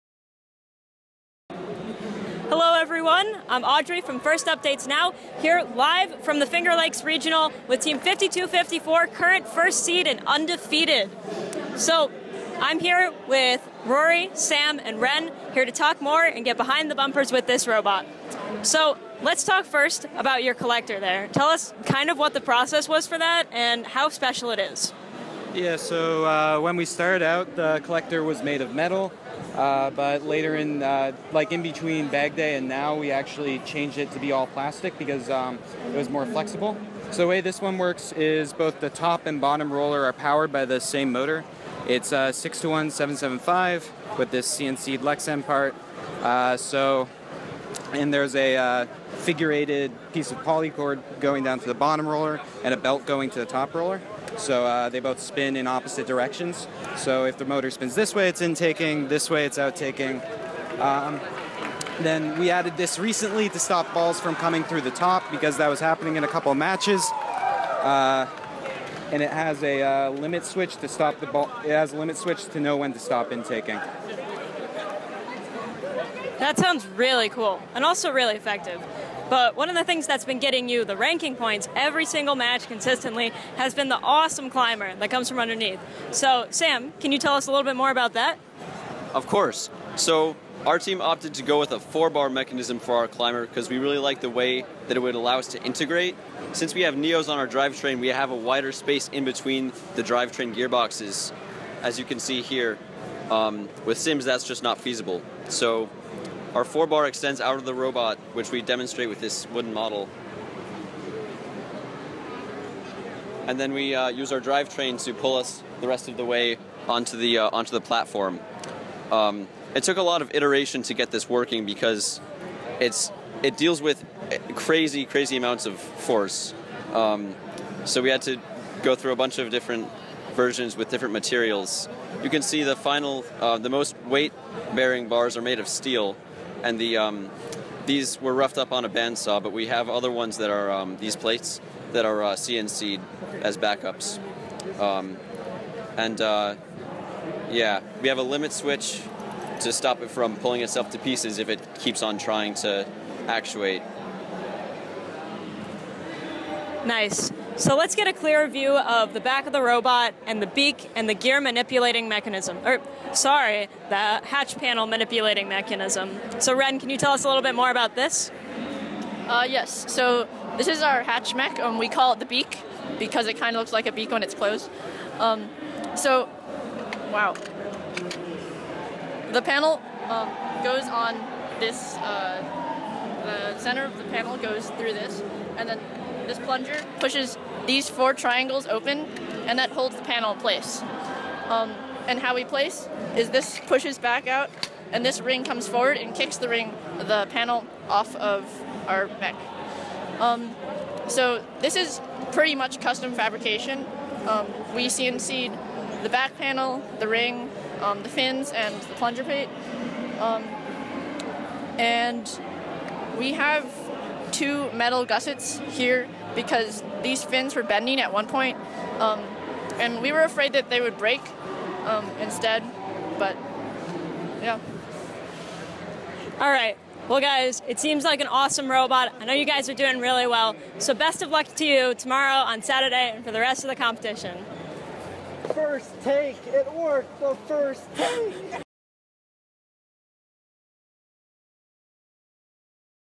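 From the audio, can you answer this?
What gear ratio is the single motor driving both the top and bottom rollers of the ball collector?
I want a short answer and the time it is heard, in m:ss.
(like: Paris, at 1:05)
6 to 1, at 0:42.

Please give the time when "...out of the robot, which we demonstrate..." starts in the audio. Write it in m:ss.
1:47.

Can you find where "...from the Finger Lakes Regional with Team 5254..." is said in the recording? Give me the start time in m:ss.
0:06.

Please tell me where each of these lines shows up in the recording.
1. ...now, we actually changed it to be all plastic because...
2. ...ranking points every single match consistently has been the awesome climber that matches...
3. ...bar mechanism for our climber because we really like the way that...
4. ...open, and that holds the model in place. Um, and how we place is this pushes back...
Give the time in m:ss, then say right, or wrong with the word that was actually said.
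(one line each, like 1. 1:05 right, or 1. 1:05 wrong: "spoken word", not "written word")
1. 0:32 right
2. 1:20 wrong: "comes", not "matches"
3. 1:32 right
4. 3:08 wrong: "panel", not "model".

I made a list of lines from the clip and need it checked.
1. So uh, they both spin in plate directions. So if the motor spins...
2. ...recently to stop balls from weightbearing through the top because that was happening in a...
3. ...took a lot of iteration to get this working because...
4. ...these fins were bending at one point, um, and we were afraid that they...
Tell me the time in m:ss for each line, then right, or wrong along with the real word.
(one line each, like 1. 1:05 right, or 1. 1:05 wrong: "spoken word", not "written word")
1. 0:54 wrong: "opposite", not "plate"
2. 1:02 wrong: "coming", not "weightbearing"
3. 1:59 right
4. 3:37 right.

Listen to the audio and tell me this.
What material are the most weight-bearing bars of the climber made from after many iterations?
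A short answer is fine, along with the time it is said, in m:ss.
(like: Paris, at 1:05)
steel, at 2:15.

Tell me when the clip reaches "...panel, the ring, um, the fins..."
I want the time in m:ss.
3:26.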